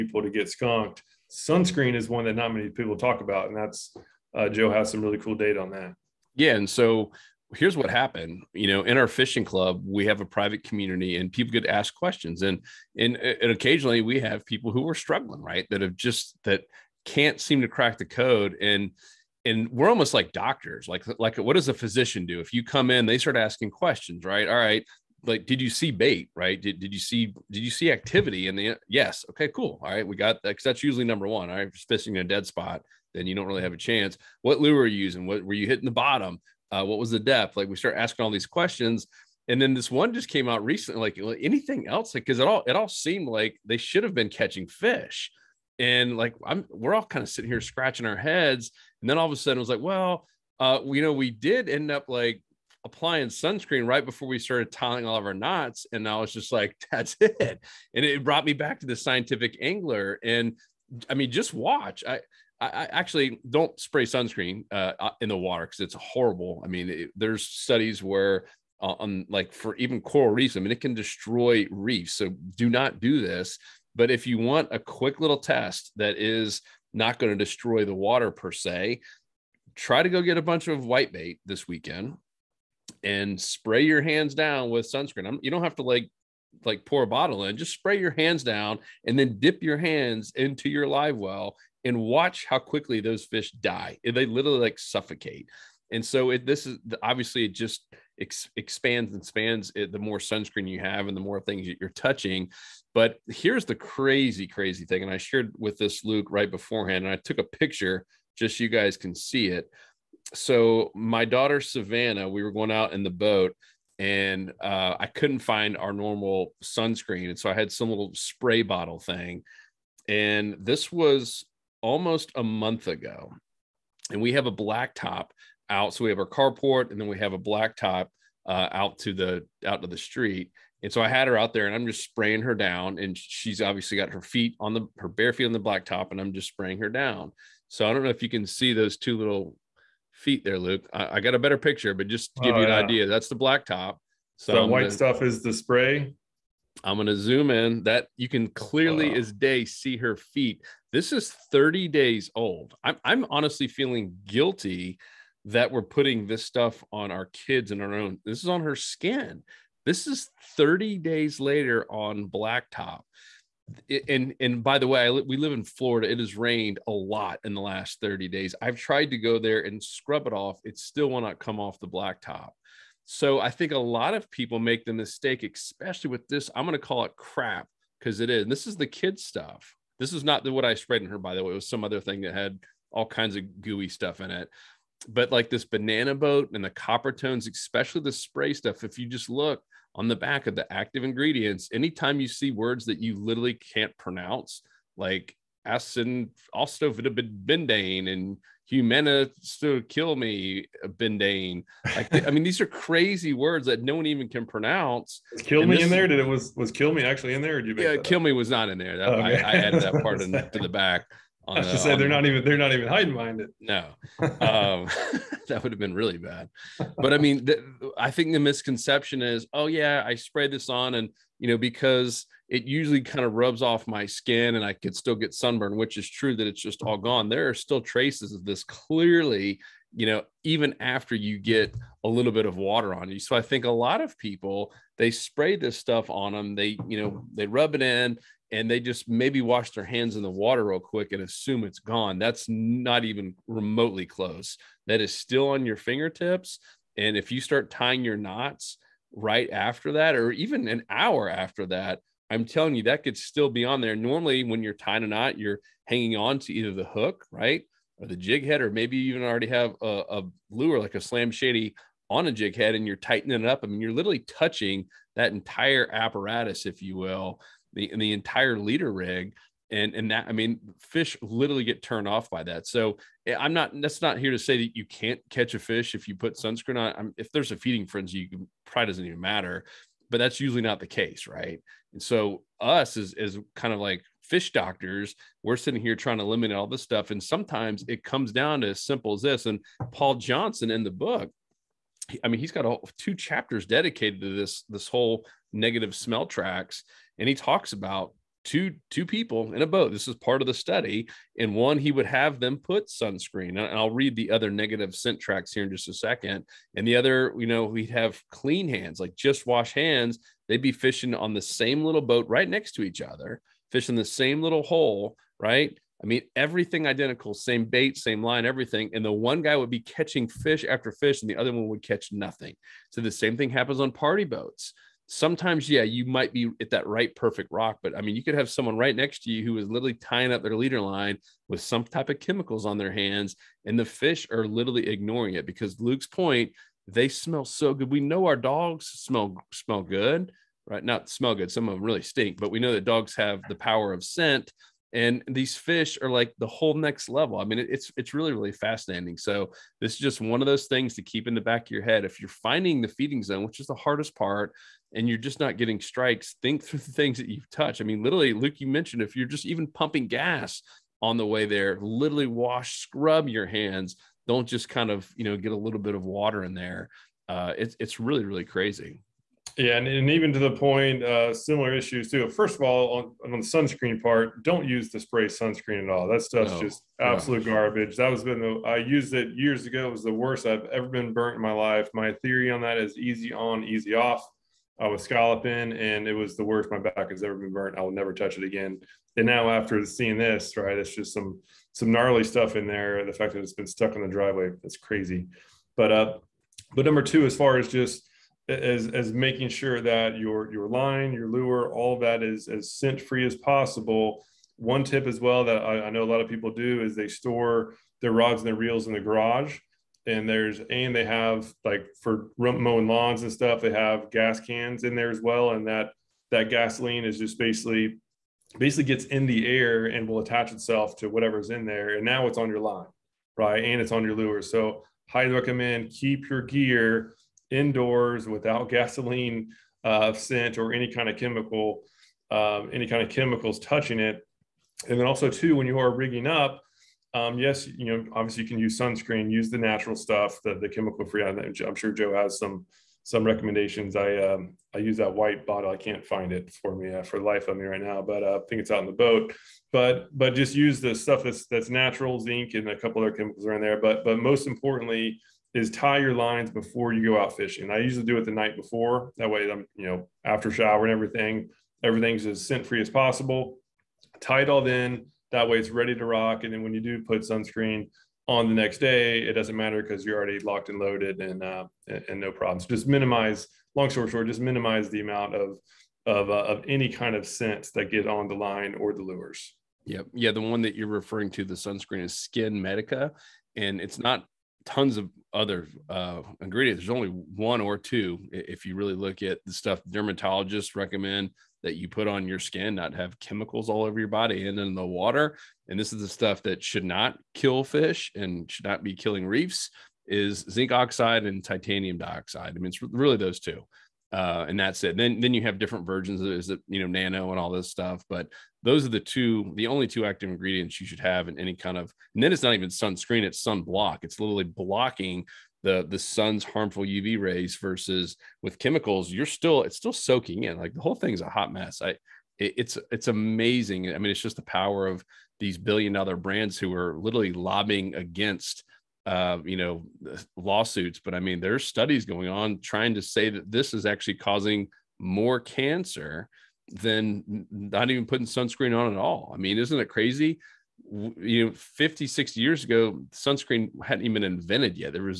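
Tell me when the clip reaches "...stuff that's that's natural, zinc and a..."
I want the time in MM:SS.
07:30.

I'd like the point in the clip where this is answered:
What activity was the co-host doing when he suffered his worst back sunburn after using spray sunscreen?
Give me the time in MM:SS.
06:25.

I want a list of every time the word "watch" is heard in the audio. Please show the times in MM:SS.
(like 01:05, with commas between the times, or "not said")
01:01, 01:31.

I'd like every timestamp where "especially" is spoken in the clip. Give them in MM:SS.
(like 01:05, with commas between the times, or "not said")
02:55, 03:07.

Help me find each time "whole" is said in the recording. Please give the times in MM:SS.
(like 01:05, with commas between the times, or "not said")
04:54, 05:46, 08:40.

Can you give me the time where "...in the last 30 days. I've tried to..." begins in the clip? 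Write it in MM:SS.
02:47.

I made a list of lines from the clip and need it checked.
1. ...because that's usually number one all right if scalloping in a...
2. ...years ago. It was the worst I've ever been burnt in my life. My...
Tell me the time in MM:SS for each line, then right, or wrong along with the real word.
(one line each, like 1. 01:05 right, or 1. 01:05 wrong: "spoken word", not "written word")
1. 00:30 wrong: "fishing", not "scalloping"
2. 06:19 right.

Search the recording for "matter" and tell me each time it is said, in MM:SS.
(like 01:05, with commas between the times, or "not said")
04:39, 07:49.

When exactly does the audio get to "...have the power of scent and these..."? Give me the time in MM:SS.
05:43.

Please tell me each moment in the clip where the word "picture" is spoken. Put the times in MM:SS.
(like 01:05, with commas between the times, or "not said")
01:47, 02:21.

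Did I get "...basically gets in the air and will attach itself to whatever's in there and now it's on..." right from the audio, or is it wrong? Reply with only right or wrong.
right.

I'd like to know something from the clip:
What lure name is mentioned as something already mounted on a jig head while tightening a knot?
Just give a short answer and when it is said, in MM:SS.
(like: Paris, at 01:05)
Slam Shady, at 04:21.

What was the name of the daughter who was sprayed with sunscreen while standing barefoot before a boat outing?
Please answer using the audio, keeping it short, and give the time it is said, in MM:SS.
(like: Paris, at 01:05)
Savannah, at 01:51.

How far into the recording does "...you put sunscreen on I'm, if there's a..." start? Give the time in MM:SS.
04:36.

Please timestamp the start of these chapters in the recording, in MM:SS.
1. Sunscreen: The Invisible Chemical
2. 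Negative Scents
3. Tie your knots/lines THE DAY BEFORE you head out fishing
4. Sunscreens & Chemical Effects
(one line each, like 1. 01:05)
1. 01:14
2. 04:49
3. 07:29
4. 07:54.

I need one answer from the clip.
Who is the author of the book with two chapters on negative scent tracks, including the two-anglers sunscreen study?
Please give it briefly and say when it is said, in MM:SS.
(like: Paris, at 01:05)
Paul Johnson, at 04:49.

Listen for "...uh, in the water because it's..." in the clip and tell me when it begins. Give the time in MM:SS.
01:04.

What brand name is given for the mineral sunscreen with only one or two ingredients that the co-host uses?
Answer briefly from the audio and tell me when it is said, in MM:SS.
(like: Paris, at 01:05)
SkinMedica, at 08:02.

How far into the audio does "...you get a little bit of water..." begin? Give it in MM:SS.
03:51.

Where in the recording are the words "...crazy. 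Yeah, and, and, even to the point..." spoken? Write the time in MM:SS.
06:08.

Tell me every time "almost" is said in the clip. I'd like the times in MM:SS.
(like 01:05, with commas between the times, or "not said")
00:19, 02:01.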